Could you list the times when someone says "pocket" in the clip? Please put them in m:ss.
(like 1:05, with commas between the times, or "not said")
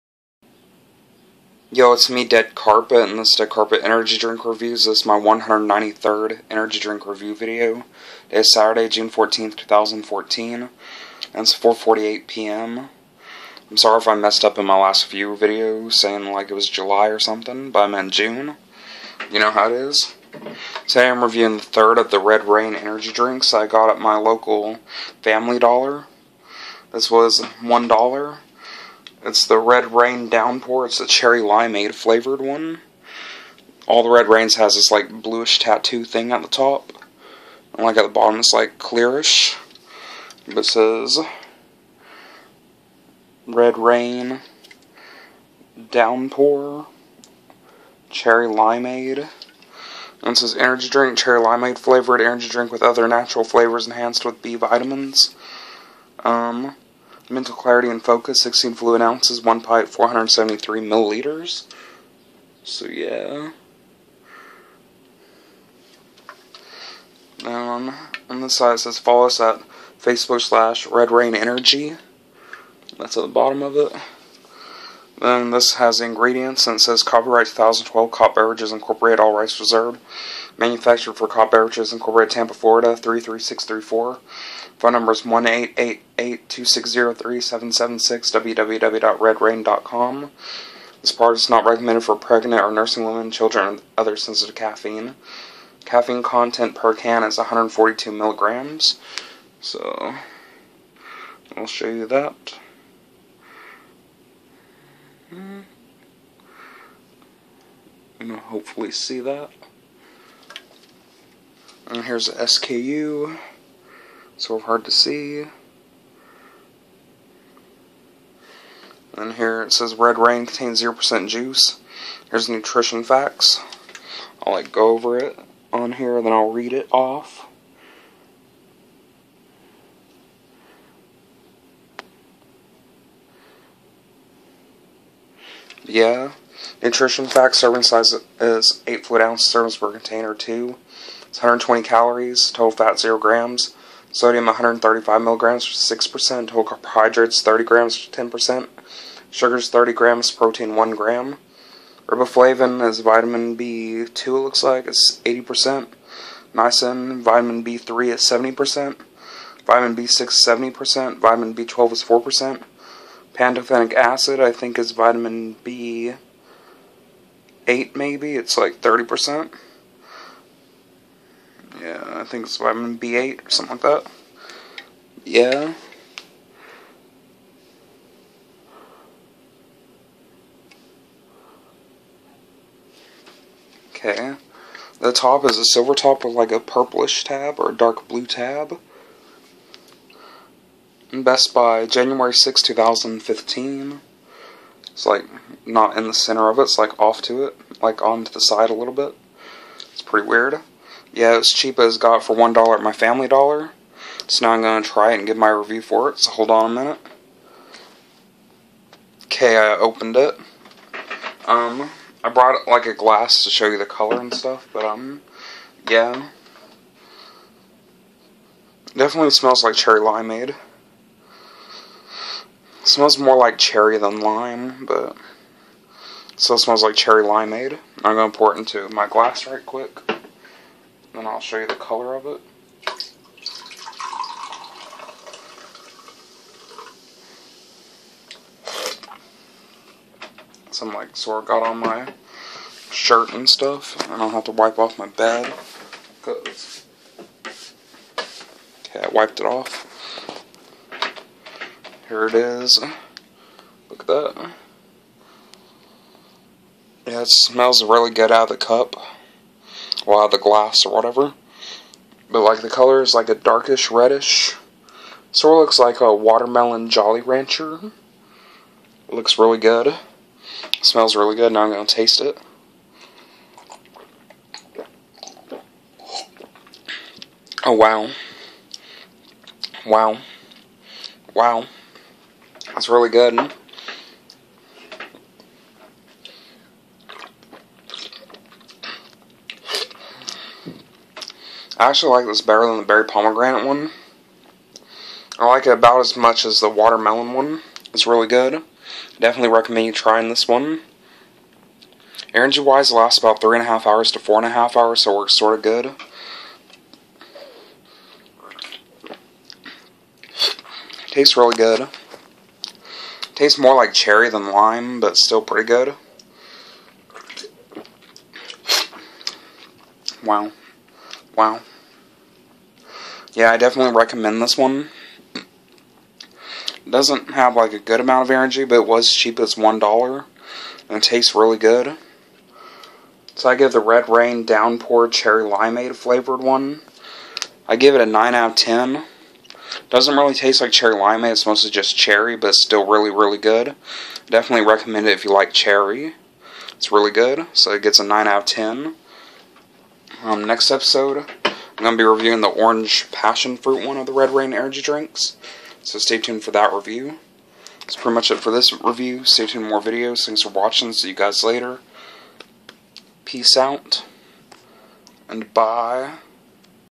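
not said.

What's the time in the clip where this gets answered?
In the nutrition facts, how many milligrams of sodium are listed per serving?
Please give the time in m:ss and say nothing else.
2:24.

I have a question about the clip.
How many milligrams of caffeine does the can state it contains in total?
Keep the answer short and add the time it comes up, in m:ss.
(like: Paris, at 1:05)
142 milligrams, at 1:37.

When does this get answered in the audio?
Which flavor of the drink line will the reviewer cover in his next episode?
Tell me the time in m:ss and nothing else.
5:52.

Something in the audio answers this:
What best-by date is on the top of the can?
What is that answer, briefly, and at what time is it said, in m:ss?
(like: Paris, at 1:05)
January 6, 2015, at 3:11.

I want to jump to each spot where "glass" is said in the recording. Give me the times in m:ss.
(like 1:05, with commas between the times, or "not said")
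3:32, 3:49, 4:20.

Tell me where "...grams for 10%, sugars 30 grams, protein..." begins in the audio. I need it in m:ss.
2:27.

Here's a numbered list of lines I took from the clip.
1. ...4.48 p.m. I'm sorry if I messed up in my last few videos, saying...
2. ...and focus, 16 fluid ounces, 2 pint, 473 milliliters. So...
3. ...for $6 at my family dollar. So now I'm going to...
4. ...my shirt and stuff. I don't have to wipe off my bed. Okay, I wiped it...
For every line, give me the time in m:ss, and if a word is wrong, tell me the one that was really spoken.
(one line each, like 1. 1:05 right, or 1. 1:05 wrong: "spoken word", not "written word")
1. 0:11 right
2. 0:57 wrong: "1", not "2"
3. 3:22 wrong: "1", not "6"
4. 4:01 right.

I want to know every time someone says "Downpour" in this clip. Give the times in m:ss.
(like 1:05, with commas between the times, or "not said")
0:30, 0:45, 5:34.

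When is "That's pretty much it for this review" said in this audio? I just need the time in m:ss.
5:57.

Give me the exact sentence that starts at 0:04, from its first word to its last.
This is my 193rd Energy Drink Review video.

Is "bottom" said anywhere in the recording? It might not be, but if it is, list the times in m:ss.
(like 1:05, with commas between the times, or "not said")
0:38, 1:13.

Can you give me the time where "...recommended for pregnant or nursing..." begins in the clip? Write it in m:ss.
1:31.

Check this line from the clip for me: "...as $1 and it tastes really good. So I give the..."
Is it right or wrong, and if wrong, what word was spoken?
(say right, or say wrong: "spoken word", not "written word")
right.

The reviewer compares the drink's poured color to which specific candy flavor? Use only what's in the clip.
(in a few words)
Watermelon Jolly Rancher.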